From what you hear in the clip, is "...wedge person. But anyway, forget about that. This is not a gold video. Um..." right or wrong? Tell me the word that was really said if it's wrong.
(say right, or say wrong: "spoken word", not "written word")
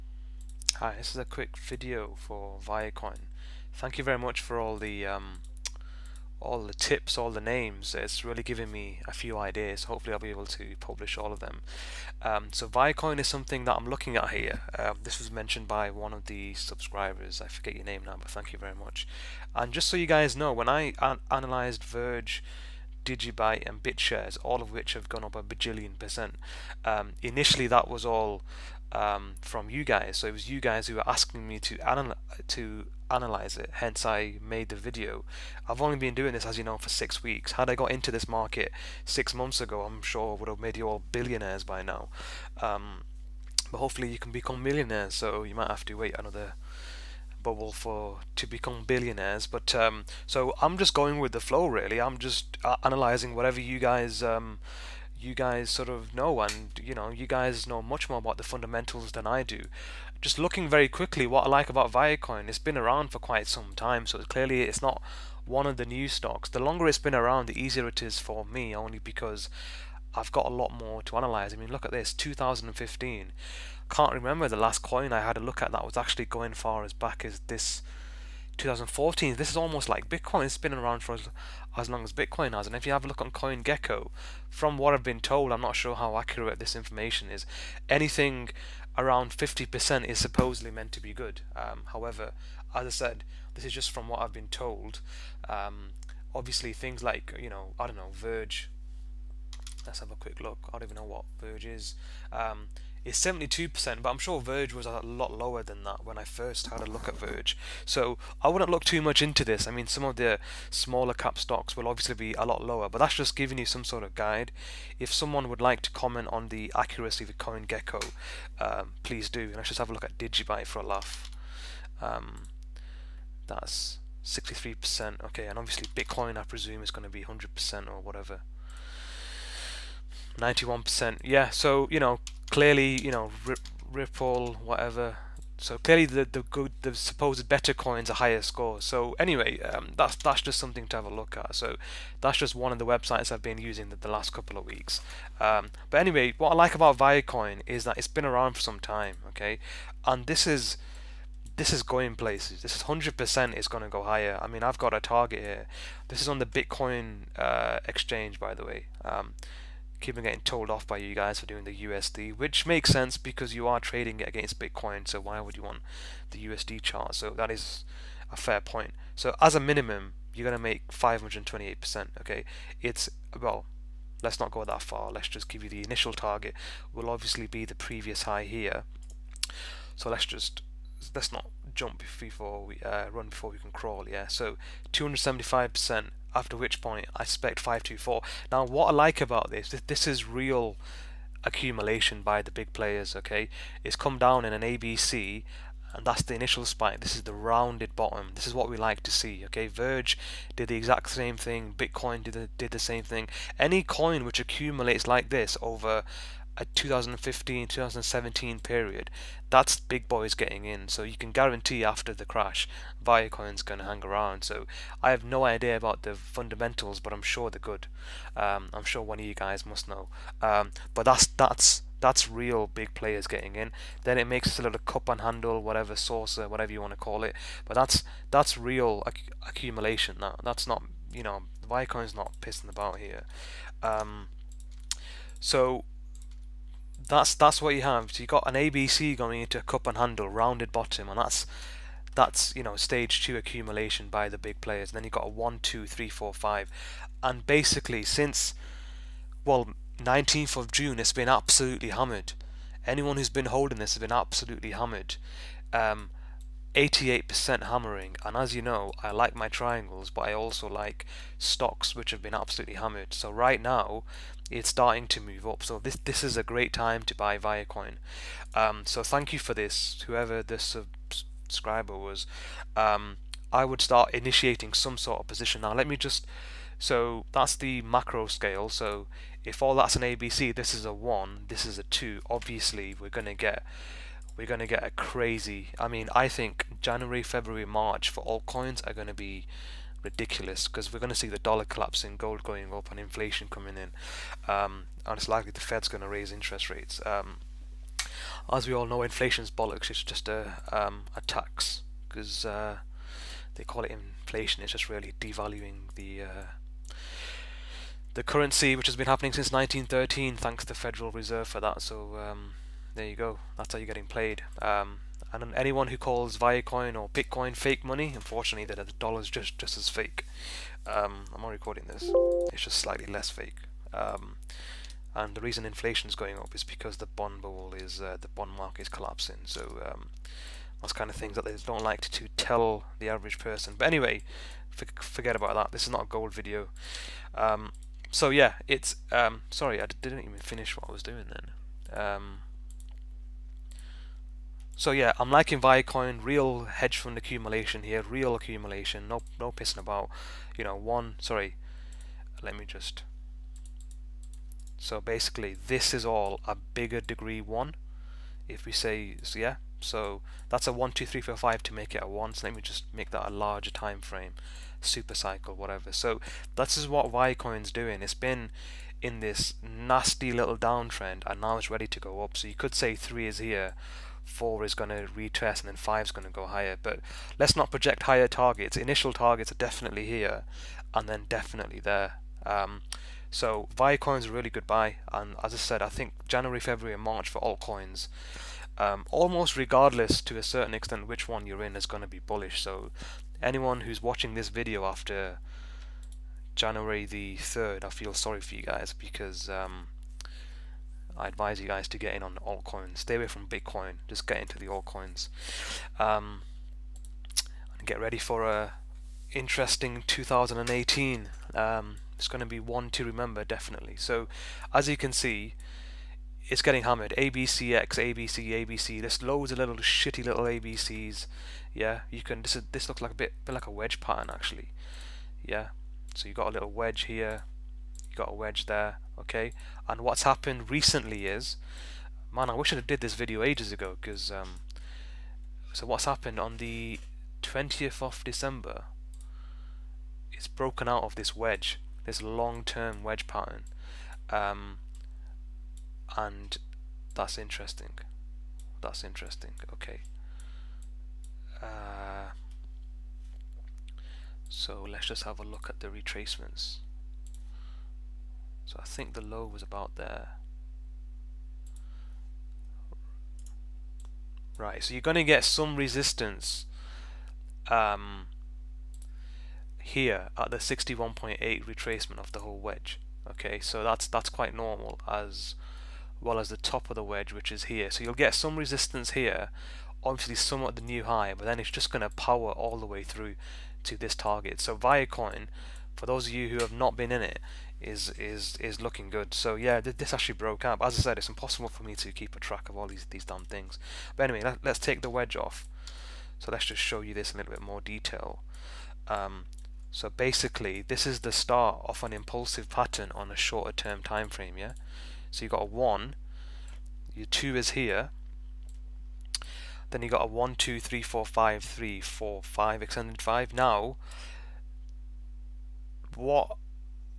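wrong: "average", not "wedge".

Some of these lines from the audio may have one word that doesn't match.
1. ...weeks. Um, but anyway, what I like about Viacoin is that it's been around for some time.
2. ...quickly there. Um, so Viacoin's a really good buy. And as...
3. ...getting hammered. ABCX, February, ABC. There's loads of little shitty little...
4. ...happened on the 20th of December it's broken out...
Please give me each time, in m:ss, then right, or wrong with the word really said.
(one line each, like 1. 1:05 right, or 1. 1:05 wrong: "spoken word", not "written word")
1. 2:24 right
2. 6:21 wrong: "definitely", not "quickly"
3. 6:56 wrong: "ABC", not "February"
4. 7:16 right.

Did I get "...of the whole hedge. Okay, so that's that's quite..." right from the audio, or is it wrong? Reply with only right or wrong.
wrong.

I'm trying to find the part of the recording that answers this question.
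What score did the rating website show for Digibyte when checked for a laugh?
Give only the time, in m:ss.
2:04.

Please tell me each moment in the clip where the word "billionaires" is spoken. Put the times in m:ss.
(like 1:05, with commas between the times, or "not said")
0:41, 0:48.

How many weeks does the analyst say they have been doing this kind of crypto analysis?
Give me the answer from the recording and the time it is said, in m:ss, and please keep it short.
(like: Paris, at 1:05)
6 weeks, at 0:36.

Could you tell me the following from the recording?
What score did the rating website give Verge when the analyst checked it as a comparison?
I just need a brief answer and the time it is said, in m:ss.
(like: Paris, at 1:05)
72%, at 1:43.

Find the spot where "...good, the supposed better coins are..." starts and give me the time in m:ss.
2:16.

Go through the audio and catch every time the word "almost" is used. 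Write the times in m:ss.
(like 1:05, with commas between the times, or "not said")
1:19, 6:29.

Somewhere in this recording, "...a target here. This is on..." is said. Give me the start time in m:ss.
2:34.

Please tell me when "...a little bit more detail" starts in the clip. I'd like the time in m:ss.
8:17.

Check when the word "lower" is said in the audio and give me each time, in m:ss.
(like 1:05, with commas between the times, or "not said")
1:45, 1:52.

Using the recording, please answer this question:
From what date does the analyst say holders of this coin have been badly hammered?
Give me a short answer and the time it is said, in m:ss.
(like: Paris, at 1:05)
19th of June, at 4:09.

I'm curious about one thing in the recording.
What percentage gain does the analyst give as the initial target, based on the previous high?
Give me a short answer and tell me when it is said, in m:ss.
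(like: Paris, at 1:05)
275%, at 3:04.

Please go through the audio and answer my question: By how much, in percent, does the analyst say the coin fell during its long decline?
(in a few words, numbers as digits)
88%.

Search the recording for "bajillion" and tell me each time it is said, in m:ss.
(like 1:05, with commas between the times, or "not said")
0:25.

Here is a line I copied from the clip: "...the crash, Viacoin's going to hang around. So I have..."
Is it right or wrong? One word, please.
right.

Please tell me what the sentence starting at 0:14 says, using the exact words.
Uh, this was mentioned by one of the subscribers.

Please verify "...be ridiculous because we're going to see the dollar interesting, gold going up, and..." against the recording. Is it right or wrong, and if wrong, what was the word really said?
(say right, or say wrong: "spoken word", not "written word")
wrong: "collapsing", not "interesting".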